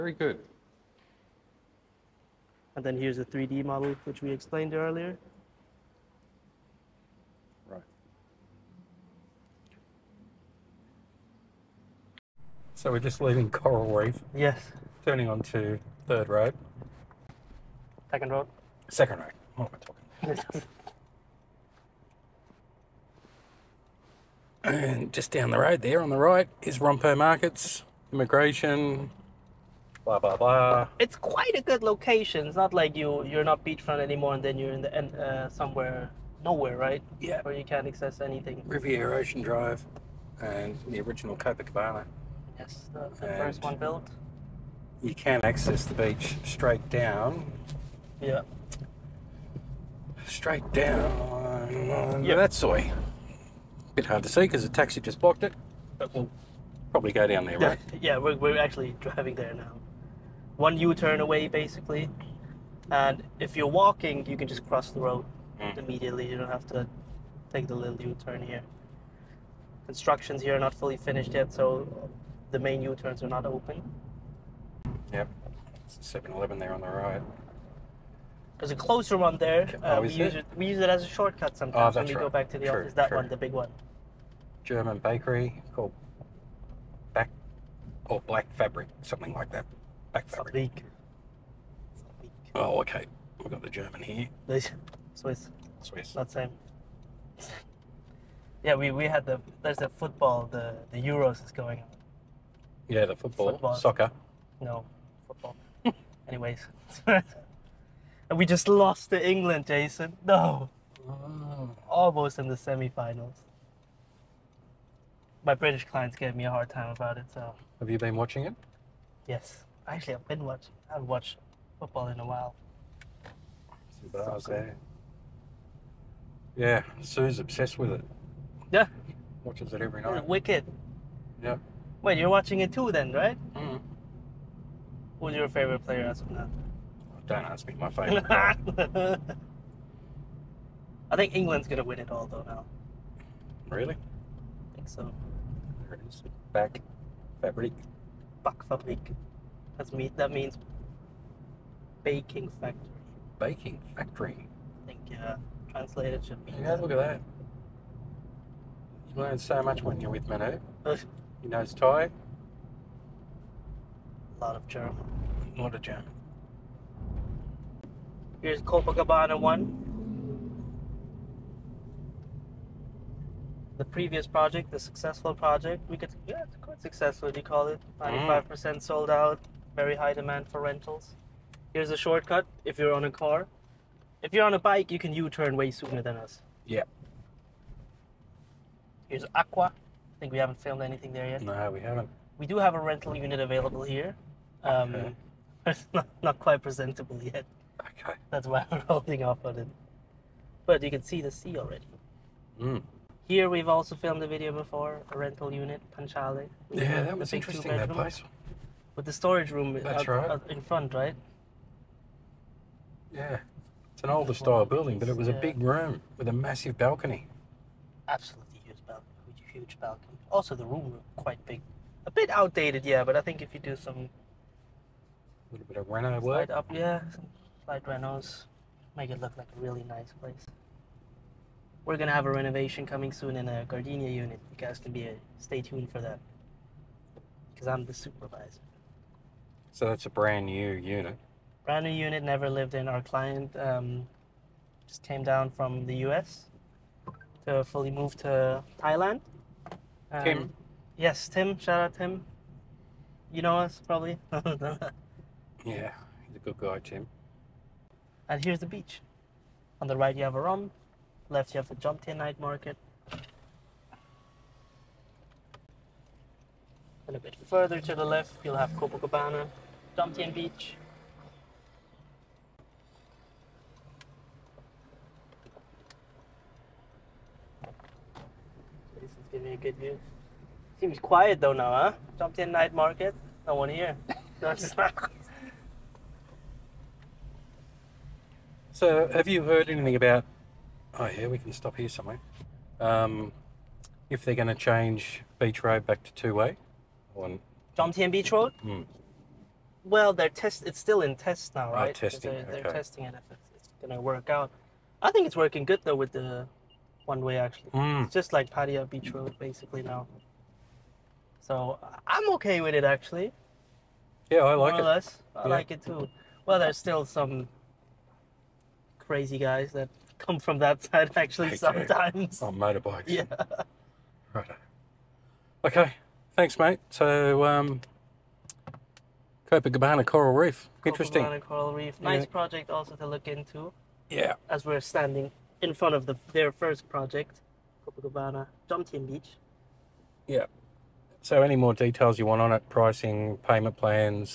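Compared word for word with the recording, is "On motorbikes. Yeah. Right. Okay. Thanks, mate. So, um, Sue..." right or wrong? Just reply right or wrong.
wrong.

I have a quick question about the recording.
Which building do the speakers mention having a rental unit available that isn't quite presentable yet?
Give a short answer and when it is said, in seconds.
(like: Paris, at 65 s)
Aqua, at 189 s.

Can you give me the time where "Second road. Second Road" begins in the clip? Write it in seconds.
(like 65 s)
18 s.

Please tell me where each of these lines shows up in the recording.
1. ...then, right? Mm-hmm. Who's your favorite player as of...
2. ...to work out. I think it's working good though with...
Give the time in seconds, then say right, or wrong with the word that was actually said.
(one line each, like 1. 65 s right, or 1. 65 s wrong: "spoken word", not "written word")
1. 132 s right
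2. 303 s right.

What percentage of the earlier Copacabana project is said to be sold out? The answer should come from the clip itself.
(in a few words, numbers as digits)
95%.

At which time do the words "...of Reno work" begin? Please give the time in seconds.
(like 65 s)
225 s.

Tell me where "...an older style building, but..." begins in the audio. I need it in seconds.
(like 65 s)
214 s.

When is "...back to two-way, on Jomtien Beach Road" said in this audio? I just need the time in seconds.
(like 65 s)
295 s.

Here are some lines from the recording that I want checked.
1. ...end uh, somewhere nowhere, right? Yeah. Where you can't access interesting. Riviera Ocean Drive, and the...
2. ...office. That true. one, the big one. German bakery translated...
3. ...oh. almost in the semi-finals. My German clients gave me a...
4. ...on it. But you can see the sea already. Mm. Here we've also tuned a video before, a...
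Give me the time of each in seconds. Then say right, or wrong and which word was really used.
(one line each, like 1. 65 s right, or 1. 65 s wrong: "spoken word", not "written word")
1. 34 s wrong: "anything", not "interesting"
2. 82 s wrong: "called", not "translated"
3. 111 s wrong: "British", not "German"
4. 199 s wrong: "filmed", not "tuned".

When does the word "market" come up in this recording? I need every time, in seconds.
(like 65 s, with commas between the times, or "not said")
27 s, 262 s, 282 s.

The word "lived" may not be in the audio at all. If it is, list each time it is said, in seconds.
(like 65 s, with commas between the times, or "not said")
242 s.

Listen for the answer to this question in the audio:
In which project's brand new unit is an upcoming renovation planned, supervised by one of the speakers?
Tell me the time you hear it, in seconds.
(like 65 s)
233 s.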